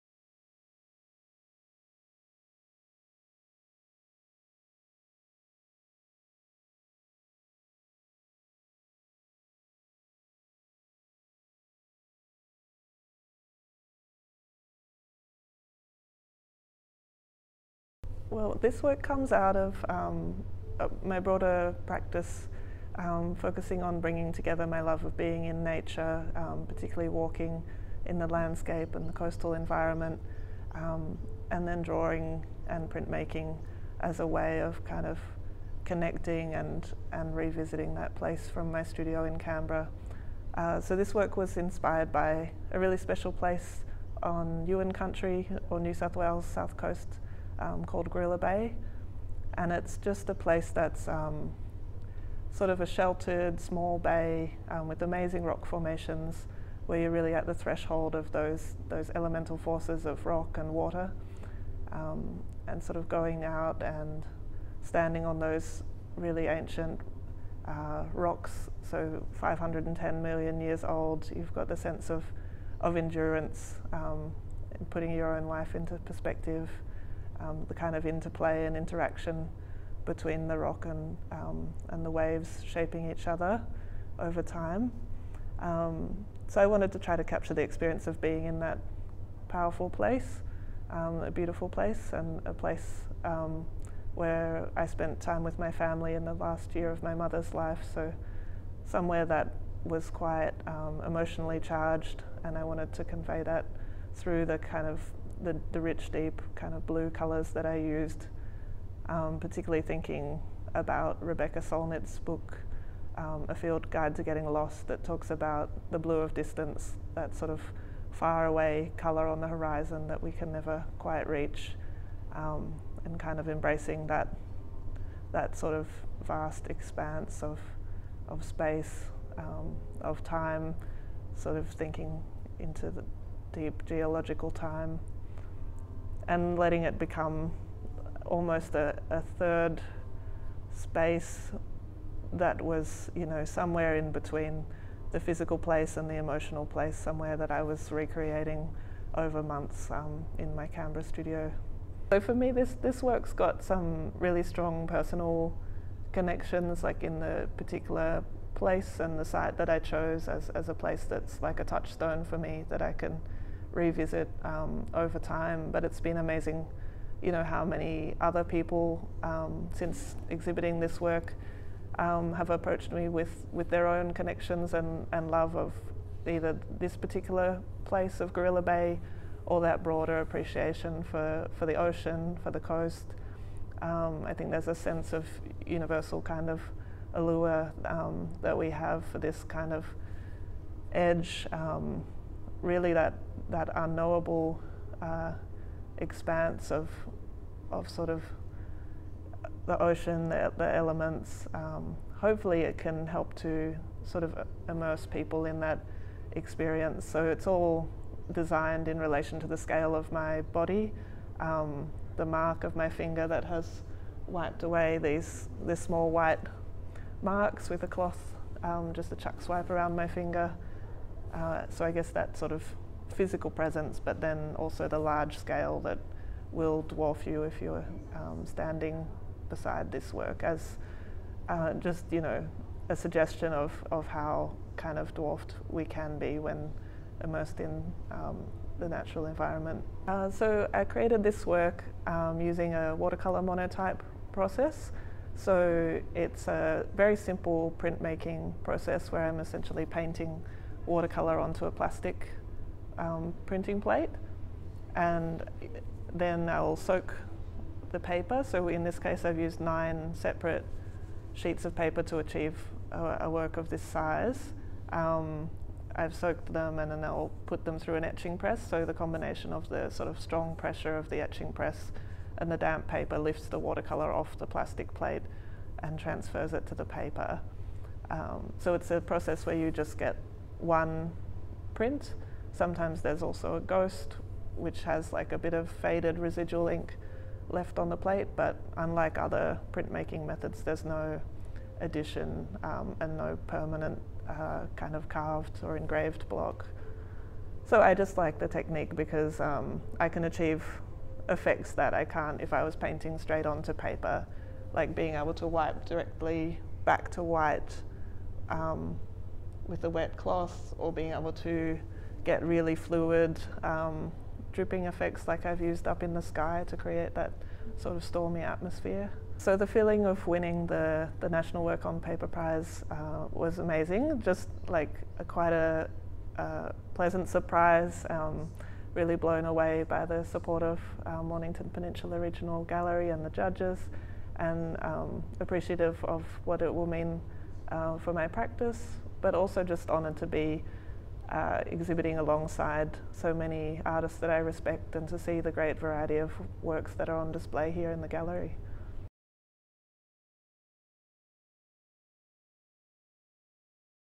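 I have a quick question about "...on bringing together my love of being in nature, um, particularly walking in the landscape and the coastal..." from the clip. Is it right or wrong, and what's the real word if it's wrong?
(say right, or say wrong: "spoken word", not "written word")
right.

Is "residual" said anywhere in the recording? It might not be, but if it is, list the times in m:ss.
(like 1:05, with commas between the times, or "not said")
4:46.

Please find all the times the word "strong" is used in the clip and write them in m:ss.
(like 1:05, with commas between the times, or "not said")
2:34, 4:30.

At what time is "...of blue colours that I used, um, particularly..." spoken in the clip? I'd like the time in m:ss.
1:46.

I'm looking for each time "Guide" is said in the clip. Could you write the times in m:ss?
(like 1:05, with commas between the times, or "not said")
1:53.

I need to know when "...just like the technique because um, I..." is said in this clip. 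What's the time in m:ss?
4:57.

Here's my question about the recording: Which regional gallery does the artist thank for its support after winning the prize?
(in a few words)
Mornington Peninsula Regional Gallery.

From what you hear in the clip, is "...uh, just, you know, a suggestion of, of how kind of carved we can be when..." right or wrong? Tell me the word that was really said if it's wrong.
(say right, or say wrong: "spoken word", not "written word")
wrong: "dwarfed", not "carved".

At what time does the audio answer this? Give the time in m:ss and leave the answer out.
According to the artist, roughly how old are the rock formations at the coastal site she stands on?
1:09.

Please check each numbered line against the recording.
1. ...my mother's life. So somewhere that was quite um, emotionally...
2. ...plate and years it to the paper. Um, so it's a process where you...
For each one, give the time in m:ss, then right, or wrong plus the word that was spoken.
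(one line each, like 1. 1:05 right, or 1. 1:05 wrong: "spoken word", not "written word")
1. 1:37 right
2. 4:34 wrong: "transfers", not "years".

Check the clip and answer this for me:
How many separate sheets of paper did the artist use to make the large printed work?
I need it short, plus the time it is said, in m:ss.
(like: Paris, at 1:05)
9, at 4:19.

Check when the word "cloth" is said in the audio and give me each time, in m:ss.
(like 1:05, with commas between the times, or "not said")
3:37, 5:10.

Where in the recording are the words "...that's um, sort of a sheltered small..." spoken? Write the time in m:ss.
0:50.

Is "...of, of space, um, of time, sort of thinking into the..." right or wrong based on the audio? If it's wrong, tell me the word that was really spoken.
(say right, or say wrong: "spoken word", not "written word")
right.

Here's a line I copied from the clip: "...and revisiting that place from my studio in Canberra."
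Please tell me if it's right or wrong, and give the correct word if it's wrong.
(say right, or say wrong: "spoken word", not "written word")
right.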